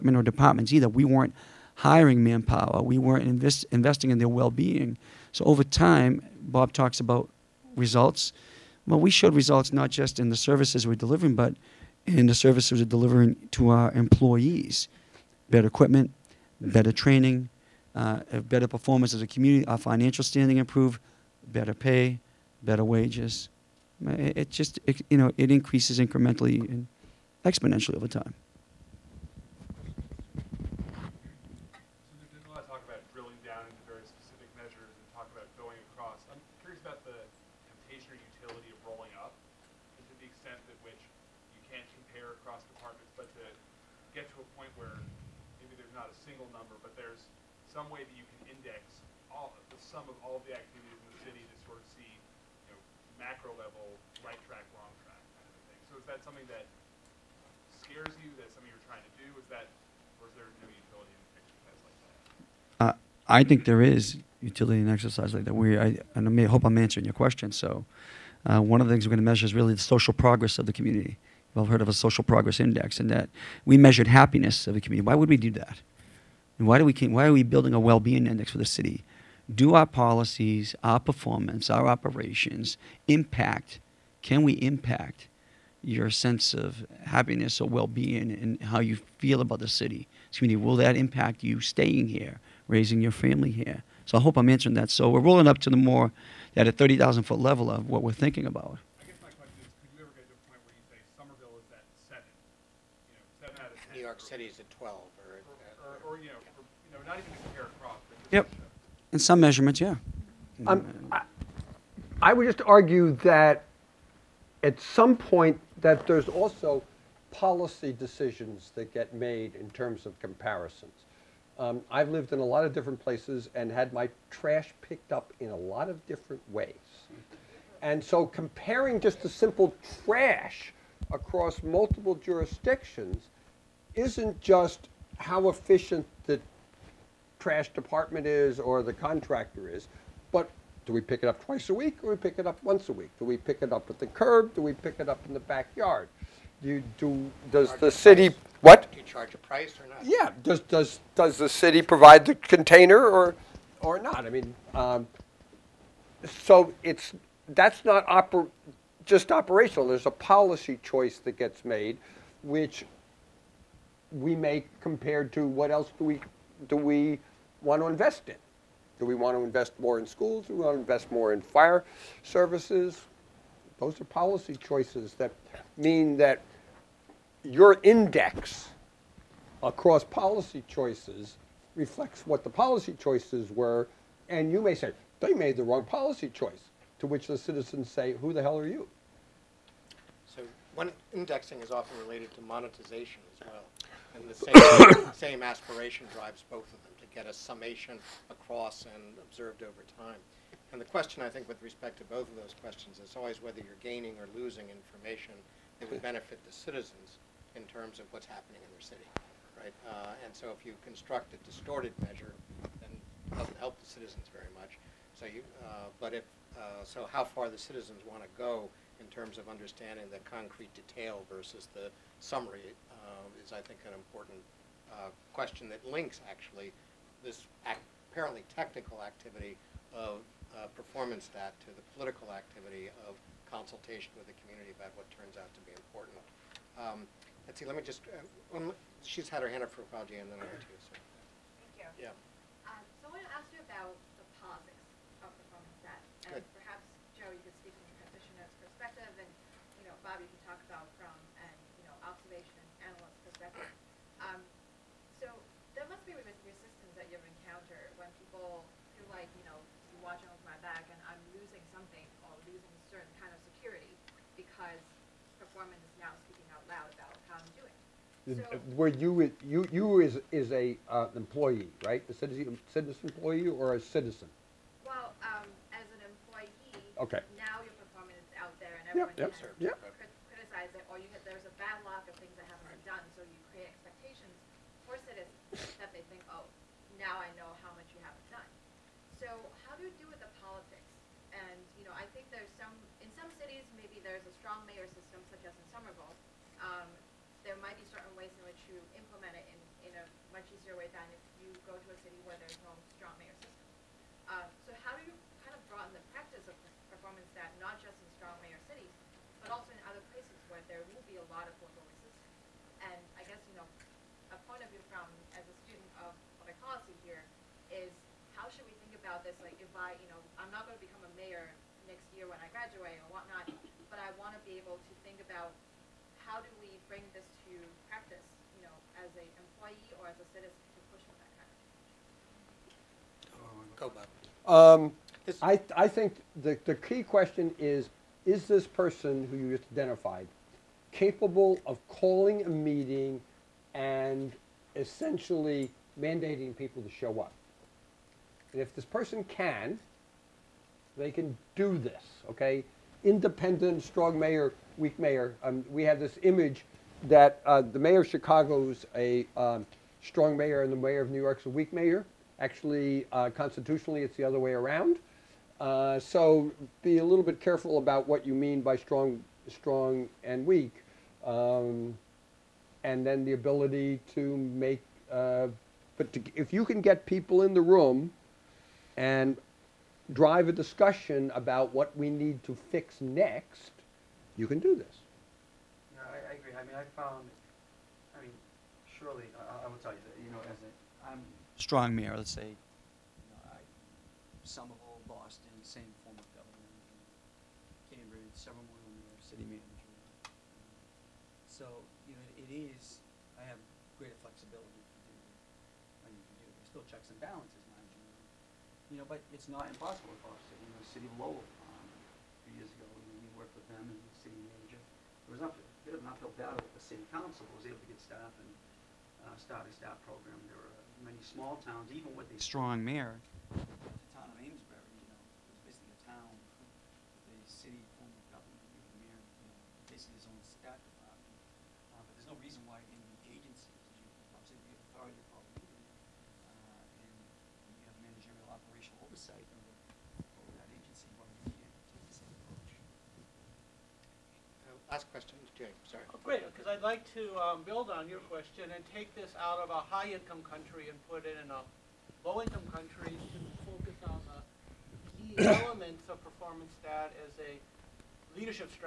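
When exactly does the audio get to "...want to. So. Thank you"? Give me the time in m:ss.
4:00.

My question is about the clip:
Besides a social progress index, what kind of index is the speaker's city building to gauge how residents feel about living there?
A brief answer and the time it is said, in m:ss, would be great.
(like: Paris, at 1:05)
well being index, at 1:17.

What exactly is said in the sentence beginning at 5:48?
if this person can, they can do this, okay?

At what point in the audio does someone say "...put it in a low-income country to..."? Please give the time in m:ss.
7:31.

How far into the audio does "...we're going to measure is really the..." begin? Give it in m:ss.
1:09.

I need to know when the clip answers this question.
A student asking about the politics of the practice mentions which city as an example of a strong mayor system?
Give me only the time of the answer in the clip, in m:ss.
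4:55.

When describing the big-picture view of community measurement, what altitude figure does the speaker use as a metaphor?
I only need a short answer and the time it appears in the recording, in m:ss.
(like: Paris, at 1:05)
30,000 foot, at 1:36.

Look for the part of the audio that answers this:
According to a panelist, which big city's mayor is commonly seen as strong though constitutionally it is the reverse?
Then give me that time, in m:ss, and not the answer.
5:58.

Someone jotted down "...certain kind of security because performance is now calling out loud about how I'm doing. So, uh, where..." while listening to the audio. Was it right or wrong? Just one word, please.
wrong.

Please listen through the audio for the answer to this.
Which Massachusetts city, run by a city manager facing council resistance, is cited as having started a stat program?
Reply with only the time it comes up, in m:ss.
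6:51.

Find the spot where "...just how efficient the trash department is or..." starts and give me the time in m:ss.
2:14.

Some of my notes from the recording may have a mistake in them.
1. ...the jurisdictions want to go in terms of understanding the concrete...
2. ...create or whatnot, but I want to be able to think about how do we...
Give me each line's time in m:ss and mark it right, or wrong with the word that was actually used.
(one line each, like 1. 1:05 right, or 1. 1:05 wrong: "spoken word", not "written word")
1. 3:37 wrong: "citizens", not "jurisdictions"
2. 5:22 wrong: "graduate", not "create".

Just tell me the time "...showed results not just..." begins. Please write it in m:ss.
0:09.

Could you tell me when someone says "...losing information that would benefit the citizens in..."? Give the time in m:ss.
3:24.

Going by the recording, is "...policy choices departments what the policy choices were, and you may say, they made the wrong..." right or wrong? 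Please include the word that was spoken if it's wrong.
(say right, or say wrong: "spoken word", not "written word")
wrong: "reflects", not "departments".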